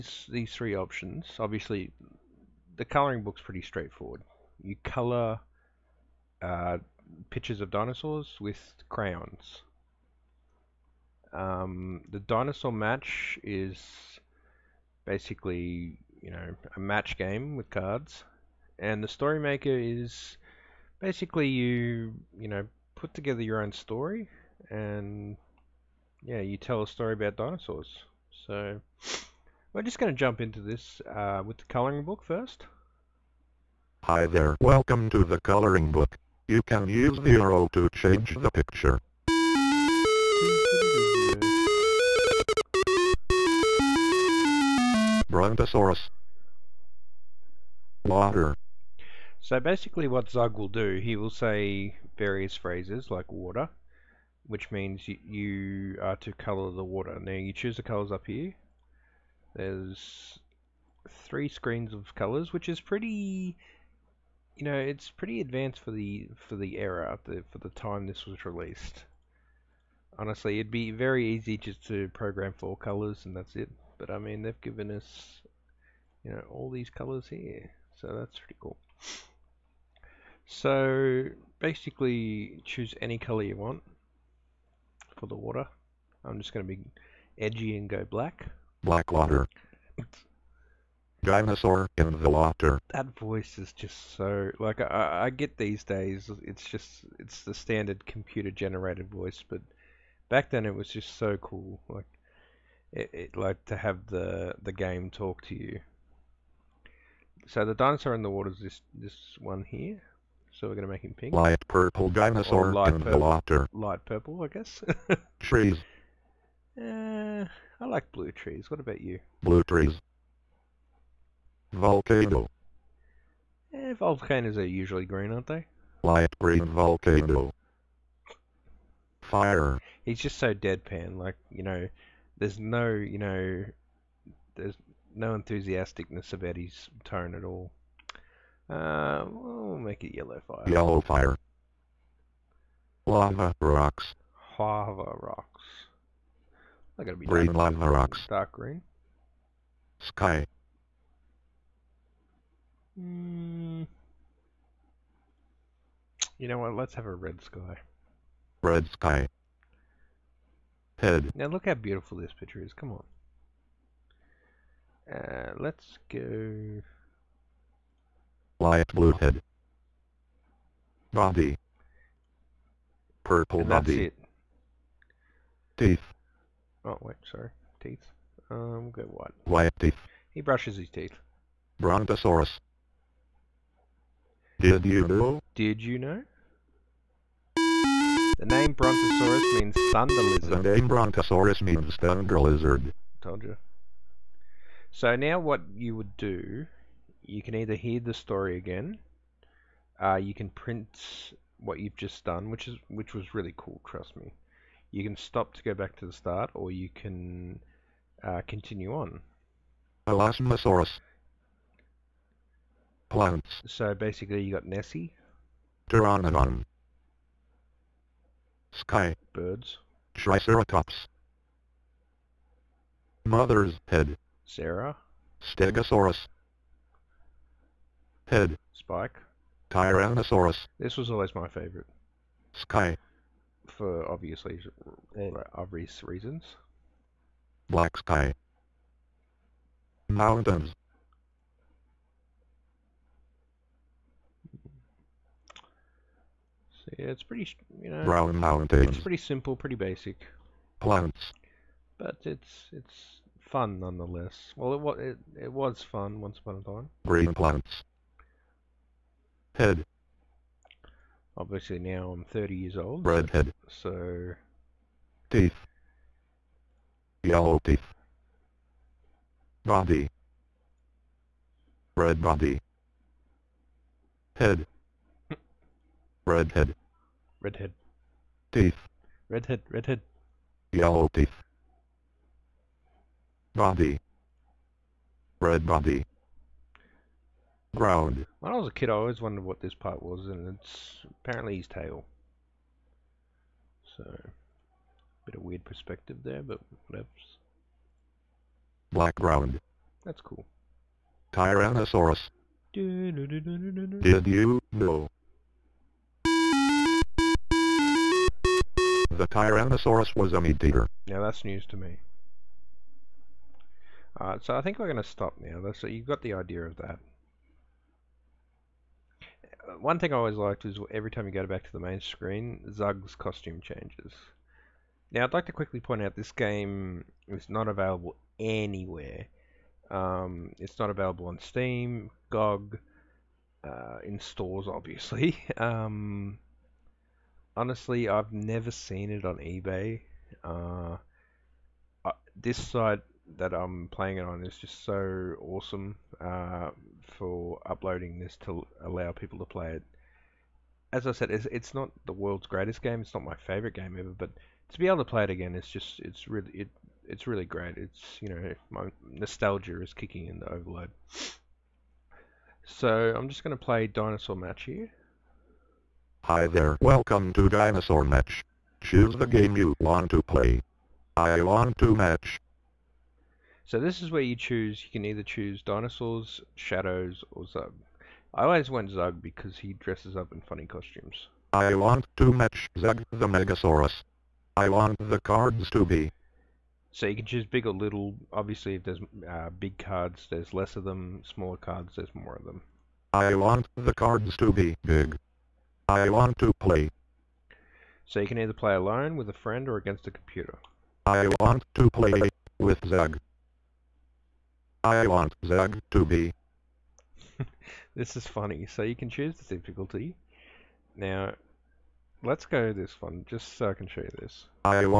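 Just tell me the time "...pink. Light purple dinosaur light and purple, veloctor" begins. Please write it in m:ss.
1:51.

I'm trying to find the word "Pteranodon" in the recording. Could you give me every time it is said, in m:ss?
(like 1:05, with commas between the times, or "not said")
3:35.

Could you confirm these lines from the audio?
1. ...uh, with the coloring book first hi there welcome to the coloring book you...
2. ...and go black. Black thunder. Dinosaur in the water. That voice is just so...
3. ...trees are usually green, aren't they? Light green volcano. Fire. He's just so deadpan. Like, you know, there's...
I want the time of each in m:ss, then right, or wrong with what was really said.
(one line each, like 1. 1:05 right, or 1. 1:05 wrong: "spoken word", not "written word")
1. 0:31 right
2. 1:27 wrong: "water", not "thunder"
3. 2:03 wrong: "volcanoes", not "trees".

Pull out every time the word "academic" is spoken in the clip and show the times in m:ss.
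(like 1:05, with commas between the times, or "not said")
not said.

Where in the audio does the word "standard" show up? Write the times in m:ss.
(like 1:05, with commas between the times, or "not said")
1:37.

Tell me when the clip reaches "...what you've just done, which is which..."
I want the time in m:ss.
3:21.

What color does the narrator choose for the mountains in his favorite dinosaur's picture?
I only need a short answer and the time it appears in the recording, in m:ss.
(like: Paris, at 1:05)
Brown, at 4:08.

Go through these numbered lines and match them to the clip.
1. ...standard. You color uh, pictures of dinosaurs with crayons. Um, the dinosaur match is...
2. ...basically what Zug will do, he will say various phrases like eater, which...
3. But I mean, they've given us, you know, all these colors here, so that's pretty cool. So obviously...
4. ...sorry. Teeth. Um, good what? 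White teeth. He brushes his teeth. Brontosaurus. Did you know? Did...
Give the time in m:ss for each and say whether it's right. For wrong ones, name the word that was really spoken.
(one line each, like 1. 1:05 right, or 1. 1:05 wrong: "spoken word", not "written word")
1. 0:03 wrong: "straightforward", not "standard"
2. 0:49 wrong: "water", not "eater"
3. 1:13 wrong: "basically", not "obviously"
4. 2:57 right.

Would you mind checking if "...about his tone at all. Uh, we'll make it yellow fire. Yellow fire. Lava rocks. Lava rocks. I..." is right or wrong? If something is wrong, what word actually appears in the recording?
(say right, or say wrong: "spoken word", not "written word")
right.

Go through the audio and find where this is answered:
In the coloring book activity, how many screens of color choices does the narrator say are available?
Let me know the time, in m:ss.
1:01.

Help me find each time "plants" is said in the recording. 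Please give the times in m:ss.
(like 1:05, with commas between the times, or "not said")
3:33, 4:10, 4:17.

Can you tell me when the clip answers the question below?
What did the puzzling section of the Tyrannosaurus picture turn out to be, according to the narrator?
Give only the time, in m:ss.
4:51.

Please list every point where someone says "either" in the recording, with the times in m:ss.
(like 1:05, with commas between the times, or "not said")
3:17, 6:15, 6:38.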